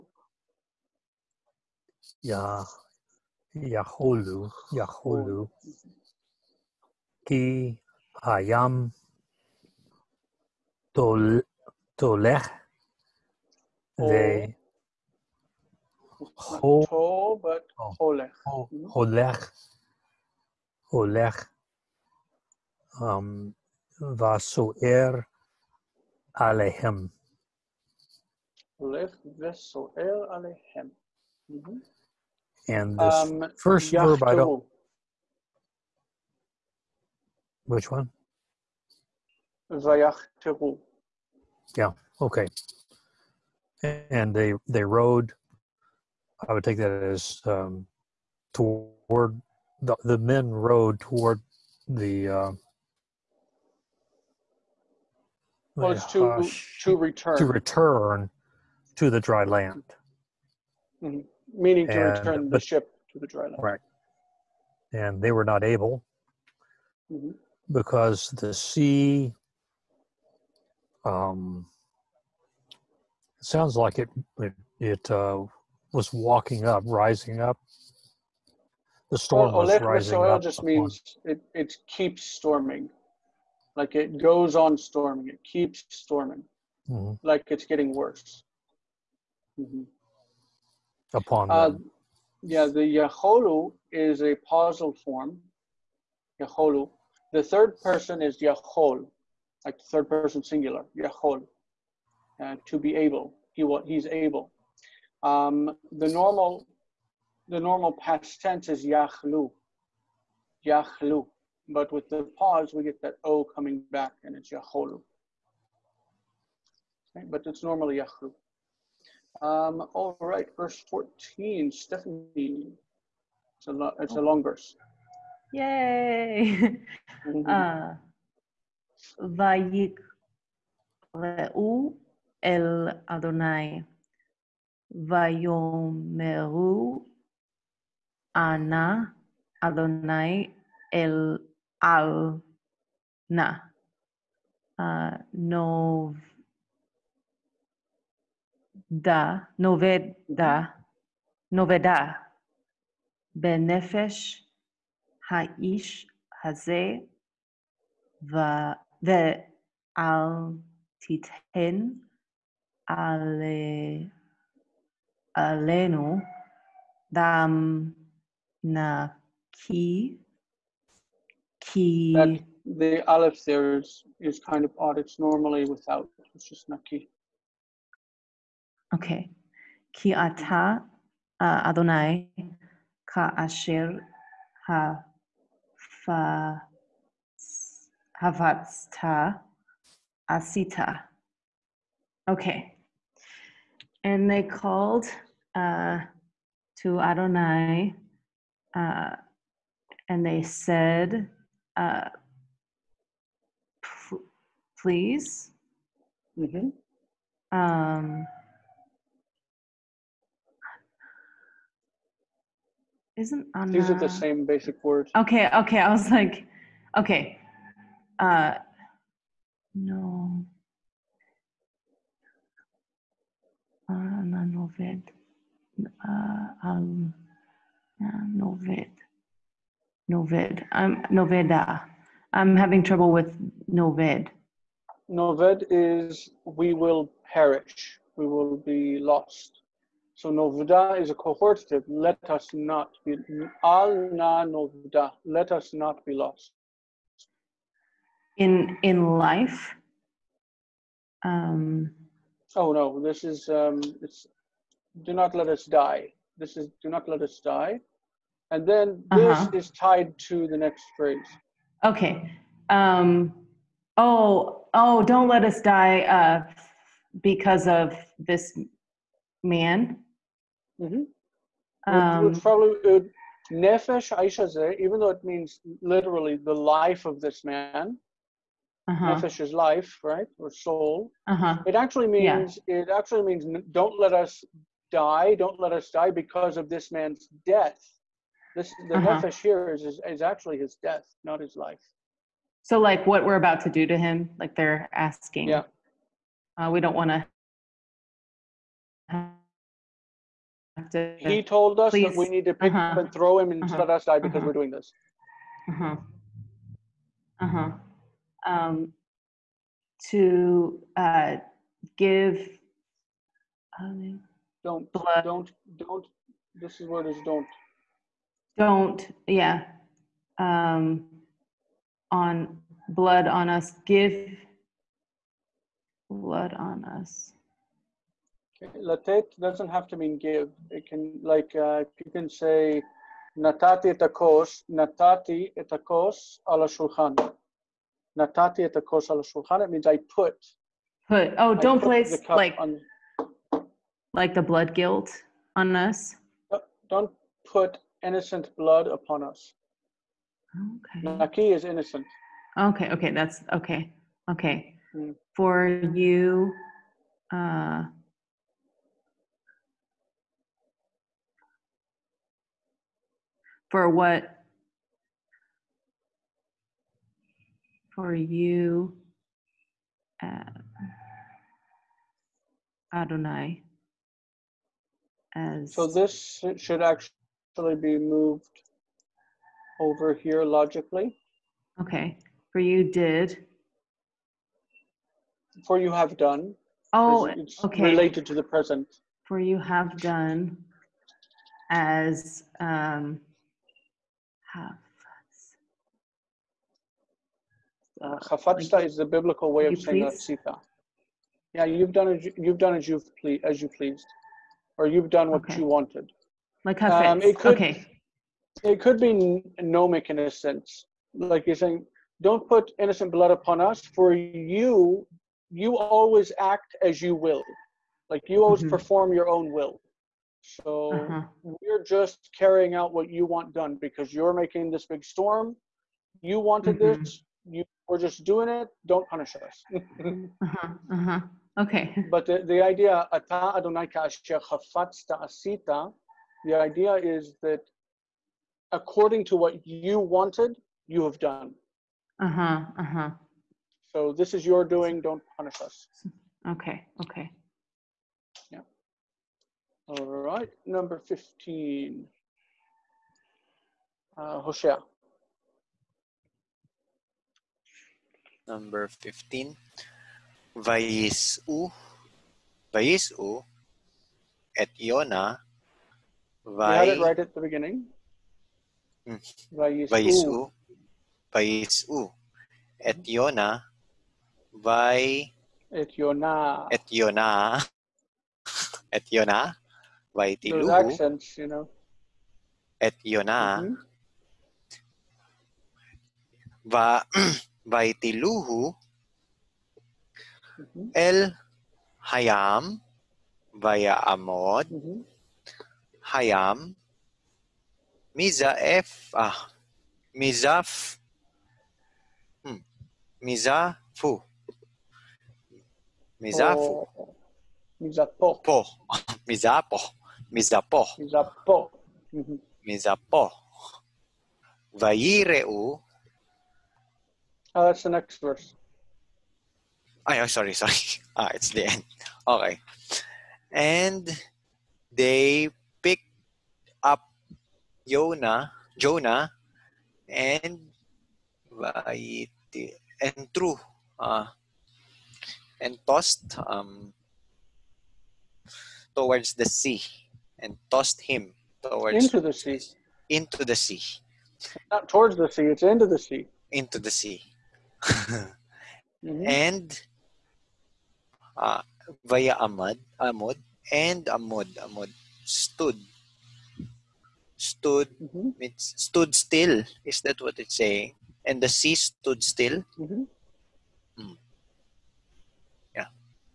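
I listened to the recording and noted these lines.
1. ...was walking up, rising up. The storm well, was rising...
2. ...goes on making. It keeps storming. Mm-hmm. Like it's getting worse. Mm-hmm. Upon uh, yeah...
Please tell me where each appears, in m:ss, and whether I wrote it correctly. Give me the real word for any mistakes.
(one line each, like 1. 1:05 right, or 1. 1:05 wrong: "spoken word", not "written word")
1. 1:15 right
2. 1:24 wrong: "storming", not "making".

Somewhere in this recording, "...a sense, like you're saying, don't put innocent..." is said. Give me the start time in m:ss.
6:50.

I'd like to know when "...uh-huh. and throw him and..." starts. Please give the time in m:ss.
5:02.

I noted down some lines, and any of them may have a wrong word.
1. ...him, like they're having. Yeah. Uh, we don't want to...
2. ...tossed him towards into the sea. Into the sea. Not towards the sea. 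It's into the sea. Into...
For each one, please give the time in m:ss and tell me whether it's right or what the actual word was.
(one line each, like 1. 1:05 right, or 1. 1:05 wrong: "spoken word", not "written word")
1. 4:53 wrong: "asking", not "having"
2. 9:00 right.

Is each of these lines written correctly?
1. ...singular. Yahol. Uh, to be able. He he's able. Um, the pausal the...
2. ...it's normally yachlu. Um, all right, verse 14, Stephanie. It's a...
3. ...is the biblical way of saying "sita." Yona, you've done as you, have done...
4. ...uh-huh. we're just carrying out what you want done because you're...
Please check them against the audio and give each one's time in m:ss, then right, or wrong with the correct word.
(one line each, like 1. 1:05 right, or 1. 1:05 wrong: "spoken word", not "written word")
1. 1:40 wrong: "normal", not "pausal"
2. 1:57 right
3. 6:38 wrong: "Yeah", not "Yona"
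4. 7:00 right.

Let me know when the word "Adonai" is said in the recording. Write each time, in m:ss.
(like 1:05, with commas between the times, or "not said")
2:13, 3:01, 3:16, 6:12, 7:13.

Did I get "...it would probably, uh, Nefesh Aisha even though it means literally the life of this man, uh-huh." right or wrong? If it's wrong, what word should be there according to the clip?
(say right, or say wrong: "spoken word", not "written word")
right.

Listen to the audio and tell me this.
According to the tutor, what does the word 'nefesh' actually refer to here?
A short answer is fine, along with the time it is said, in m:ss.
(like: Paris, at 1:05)
his death, at 4:50.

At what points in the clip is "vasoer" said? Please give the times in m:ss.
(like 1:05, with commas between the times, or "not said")
0:23, 0:29.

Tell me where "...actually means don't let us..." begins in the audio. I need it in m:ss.
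4:42.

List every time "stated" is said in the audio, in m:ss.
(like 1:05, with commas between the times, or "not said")
not said.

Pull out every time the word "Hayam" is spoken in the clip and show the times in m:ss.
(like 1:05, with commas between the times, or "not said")
8:11, 8:16.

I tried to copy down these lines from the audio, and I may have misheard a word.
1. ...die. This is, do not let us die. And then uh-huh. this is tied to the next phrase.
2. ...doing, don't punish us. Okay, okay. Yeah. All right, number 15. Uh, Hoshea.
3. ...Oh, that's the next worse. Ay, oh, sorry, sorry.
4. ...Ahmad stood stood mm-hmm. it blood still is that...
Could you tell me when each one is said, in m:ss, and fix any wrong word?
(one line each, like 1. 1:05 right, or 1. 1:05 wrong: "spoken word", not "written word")
1. 4:15 right
2. 7:24 right
3. 8:37 wrong: "verse", not "worse"
4. 9:14 wrong: "stood", not "blood".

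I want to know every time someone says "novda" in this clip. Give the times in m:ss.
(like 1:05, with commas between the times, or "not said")
4:00, 4:04.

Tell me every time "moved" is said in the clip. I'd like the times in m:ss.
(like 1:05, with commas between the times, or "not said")
6:17.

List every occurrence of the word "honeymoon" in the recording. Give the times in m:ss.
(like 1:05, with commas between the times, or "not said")
not said.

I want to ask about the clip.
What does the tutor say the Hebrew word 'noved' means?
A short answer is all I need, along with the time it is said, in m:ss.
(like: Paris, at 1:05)
we will perish, at 3:55.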